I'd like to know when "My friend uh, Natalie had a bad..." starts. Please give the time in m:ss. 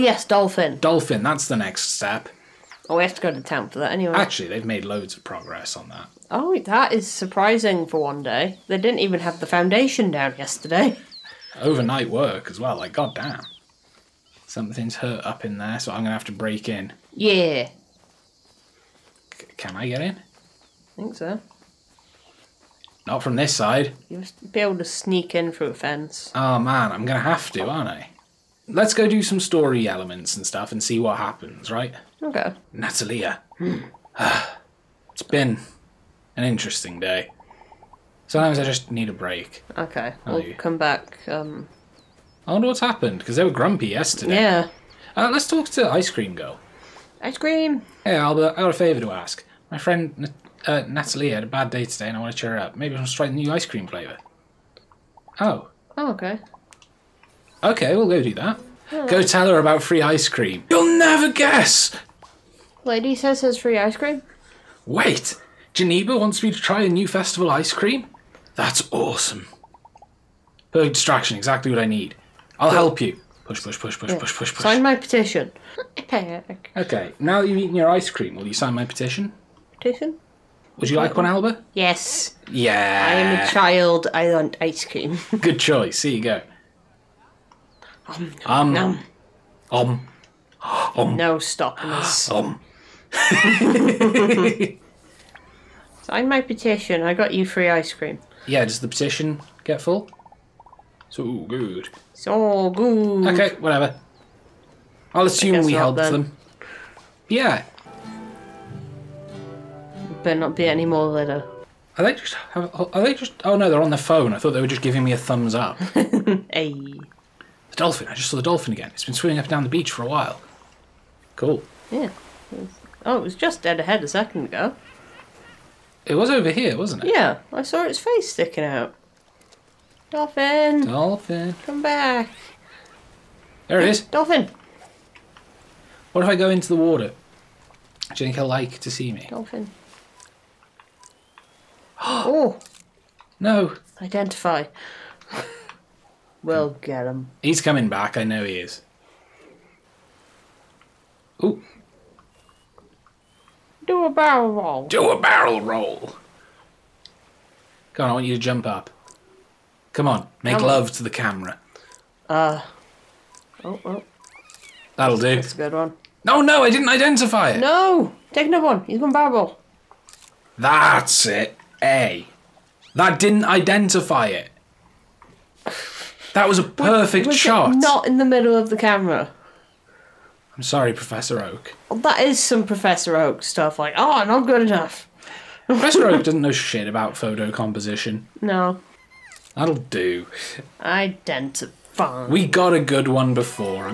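0:49.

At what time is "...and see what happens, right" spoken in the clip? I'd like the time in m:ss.
0:30.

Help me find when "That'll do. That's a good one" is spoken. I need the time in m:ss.
2:44.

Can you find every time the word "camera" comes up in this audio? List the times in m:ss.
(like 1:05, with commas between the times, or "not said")
2:41, 2:58.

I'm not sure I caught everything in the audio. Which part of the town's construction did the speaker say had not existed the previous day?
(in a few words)
foundation.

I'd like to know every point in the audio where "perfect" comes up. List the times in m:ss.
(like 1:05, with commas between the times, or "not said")
1:10, 2:56.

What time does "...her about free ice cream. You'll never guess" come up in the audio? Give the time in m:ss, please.
0:59.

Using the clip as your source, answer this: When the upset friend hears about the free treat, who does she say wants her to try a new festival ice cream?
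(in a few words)
Geneva.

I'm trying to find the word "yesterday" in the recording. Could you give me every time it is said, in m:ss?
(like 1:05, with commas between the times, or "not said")
0:10, 0:43.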